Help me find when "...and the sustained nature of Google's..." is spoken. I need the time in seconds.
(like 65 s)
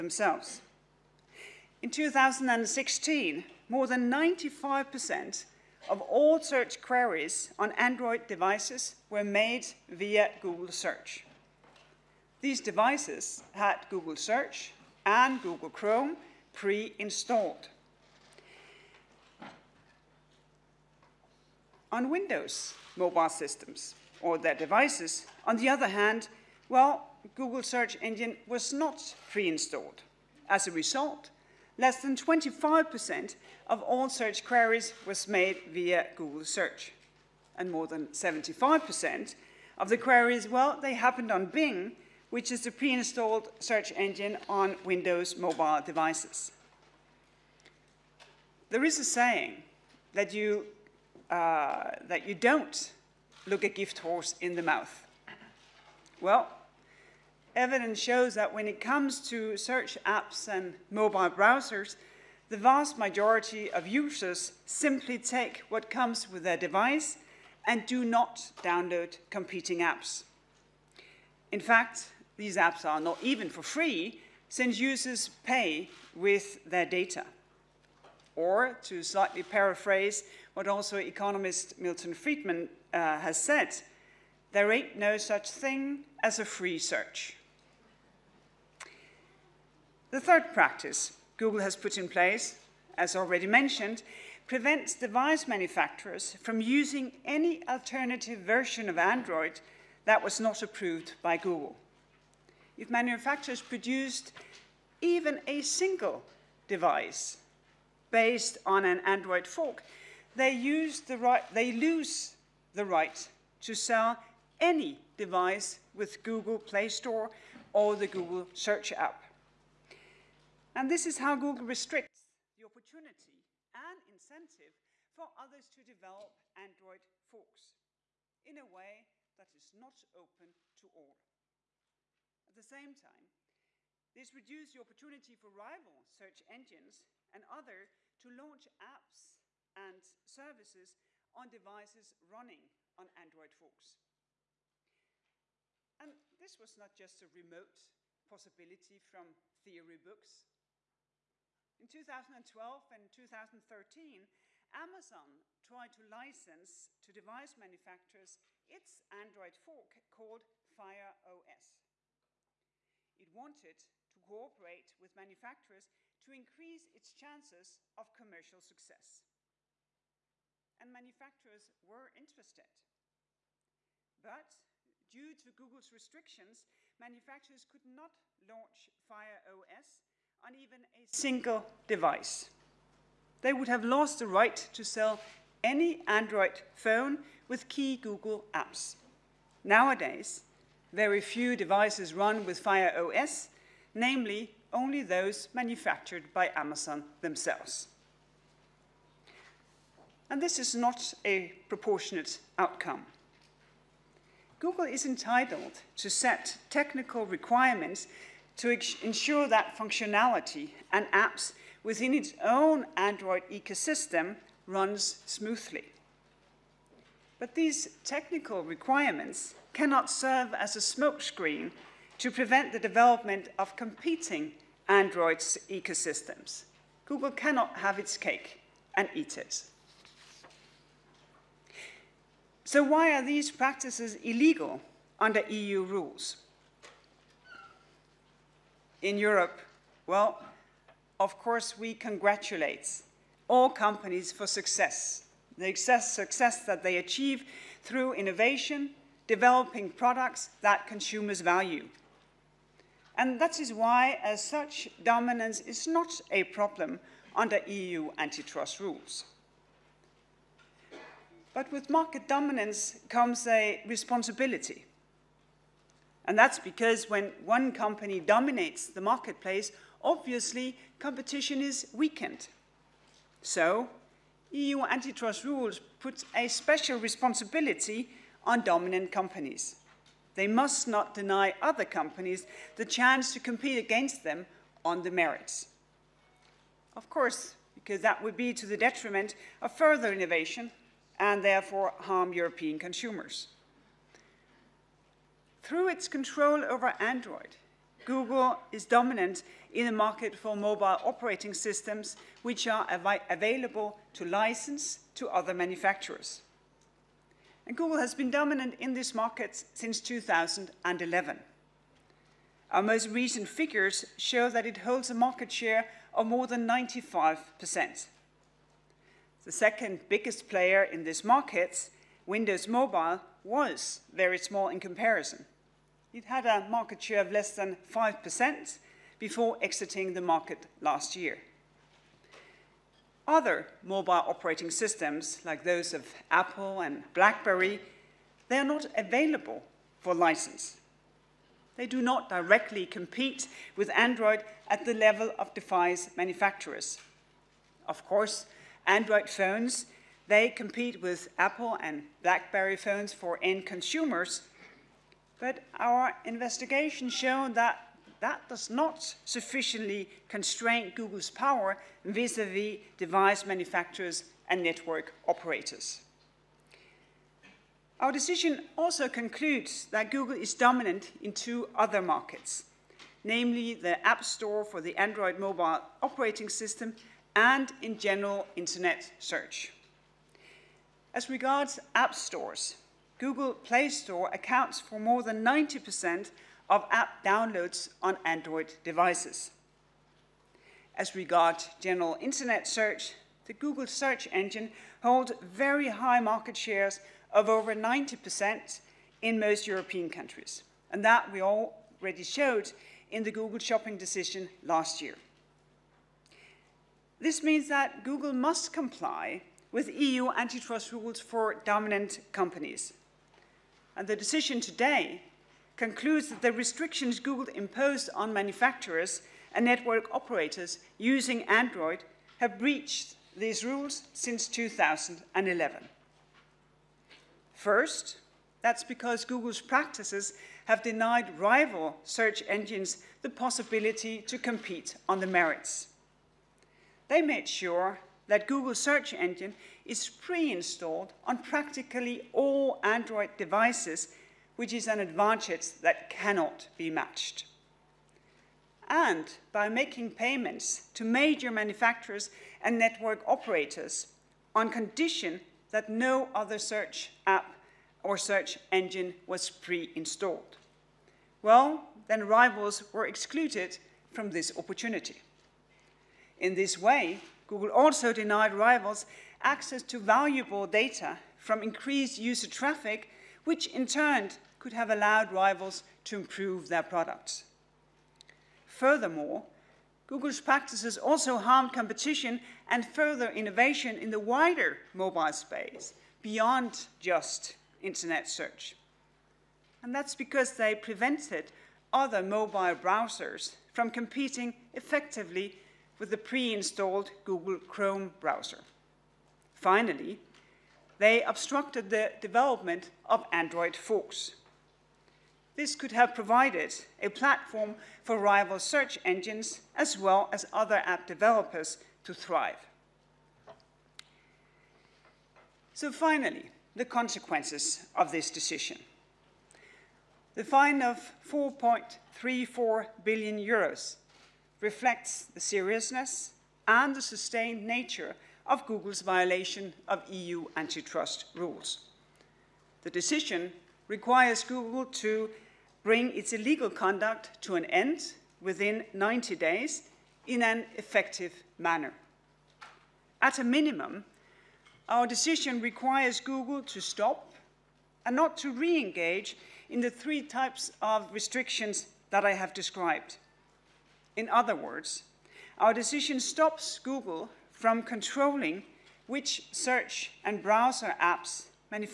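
526 s.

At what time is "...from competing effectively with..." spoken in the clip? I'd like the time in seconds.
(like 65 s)
493 s.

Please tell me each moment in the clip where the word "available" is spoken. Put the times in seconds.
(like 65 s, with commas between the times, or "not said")
303 s, 338 s.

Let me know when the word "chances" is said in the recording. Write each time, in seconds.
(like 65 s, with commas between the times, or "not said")
167 s, 282 s.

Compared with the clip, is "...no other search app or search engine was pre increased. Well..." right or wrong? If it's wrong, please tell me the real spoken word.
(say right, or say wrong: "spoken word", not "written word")
wrong: "installed", not "increased".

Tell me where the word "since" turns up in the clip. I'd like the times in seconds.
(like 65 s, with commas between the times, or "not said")
74 s, 309 s, 424 s.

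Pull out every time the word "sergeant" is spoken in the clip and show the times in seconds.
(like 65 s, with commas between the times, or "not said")
not said.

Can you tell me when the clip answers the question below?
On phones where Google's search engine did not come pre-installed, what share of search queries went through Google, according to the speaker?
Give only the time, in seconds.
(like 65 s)
31 s.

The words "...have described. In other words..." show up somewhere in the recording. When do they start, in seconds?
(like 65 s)
552 s.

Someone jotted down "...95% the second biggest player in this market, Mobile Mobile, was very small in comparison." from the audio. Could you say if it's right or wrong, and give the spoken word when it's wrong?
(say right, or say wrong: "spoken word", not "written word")
wrong: "Windows", not "Mobile".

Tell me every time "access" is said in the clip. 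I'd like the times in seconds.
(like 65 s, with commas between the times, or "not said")
469 s.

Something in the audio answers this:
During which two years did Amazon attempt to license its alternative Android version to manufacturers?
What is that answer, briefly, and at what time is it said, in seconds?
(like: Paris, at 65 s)
2012 and 2013, at 151 s.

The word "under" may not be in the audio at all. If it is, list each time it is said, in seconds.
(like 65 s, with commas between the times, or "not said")
235 s, 257 s.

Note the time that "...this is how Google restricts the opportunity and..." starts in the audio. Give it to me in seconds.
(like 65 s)
120 s.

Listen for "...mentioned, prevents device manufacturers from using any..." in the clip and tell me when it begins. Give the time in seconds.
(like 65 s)
93 s.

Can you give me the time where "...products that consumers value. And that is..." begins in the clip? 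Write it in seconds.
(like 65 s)
249 s.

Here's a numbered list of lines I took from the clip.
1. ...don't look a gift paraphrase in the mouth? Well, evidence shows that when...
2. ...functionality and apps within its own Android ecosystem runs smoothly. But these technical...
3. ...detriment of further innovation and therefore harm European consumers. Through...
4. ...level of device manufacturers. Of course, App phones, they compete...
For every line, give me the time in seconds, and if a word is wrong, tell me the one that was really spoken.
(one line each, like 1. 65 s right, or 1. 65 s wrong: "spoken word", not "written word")
1. 52 s wrong: "horse", not "paraphrase"
2. 209 s right
3. 288 s right
4. 344 s wrong: "Android", not "App".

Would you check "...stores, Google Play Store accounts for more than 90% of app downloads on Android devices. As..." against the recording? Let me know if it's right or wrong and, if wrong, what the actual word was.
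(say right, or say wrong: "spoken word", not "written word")
right.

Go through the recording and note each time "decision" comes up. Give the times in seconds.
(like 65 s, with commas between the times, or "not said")
368 s, 403 s, 414 s, 518 s, 532 s, 545 s, 555 s.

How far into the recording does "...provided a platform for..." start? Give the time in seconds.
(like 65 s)
506 s.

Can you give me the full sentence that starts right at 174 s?
But due to Google's restrictions, manufacturers could not launch Fire OS on even a single device.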